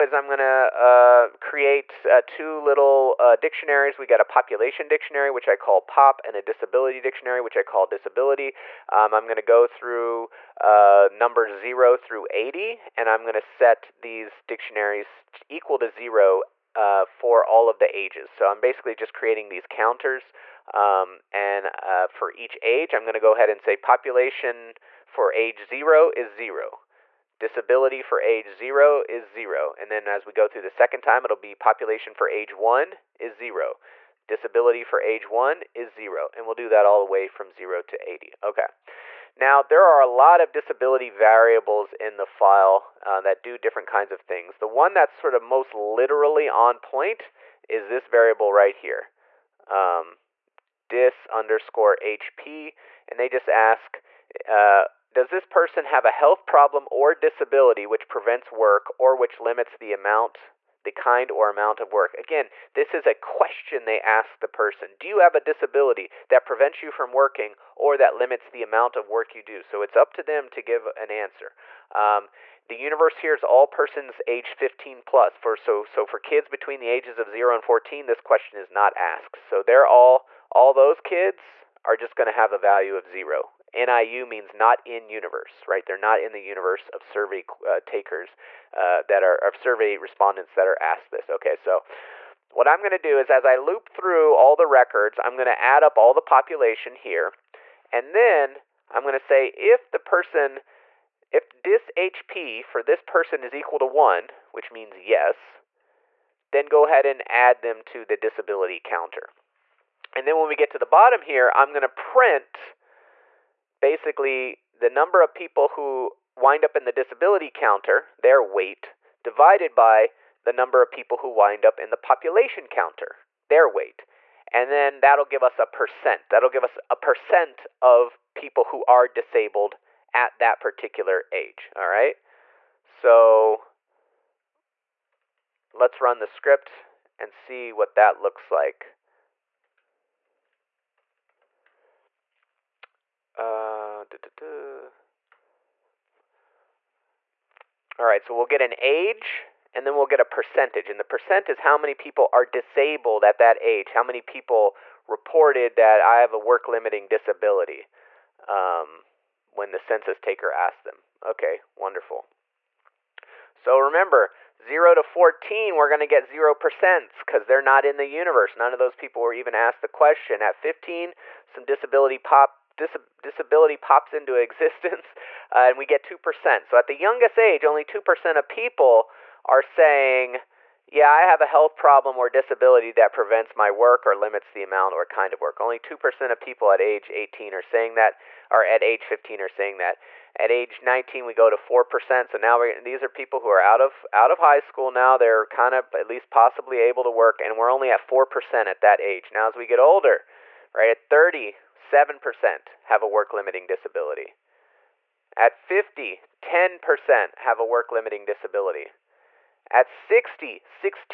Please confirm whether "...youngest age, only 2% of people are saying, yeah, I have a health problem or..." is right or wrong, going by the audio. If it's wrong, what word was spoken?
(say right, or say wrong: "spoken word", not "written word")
right.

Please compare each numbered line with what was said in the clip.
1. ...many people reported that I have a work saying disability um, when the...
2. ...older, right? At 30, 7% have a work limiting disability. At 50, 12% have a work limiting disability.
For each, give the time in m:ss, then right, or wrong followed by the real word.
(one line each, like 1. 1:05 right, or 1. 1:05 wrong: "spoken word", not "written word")
1. 2:34 wrong: "limiting", not "saying"
2. 3:19 wrong: "10", not "12".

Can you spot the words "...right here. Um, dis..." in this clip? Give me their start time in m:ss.
0:48.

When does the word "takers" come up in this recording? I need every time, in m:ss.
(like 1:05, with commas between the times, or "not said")
1:27, 2:40.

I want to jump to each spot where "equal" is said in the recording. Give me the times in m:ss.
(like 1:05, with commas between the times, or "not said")
0:15, 1:43.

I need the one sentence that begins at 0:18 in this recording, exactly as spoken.
So I'm basically just creating these counters.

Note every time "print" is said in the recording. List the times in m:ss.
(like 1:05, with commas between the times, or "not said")
1:51.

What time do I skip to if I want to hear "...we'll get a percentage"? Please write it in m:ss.
2:29.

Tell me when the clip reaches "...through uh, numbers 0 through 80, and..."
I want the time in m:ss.
0:09.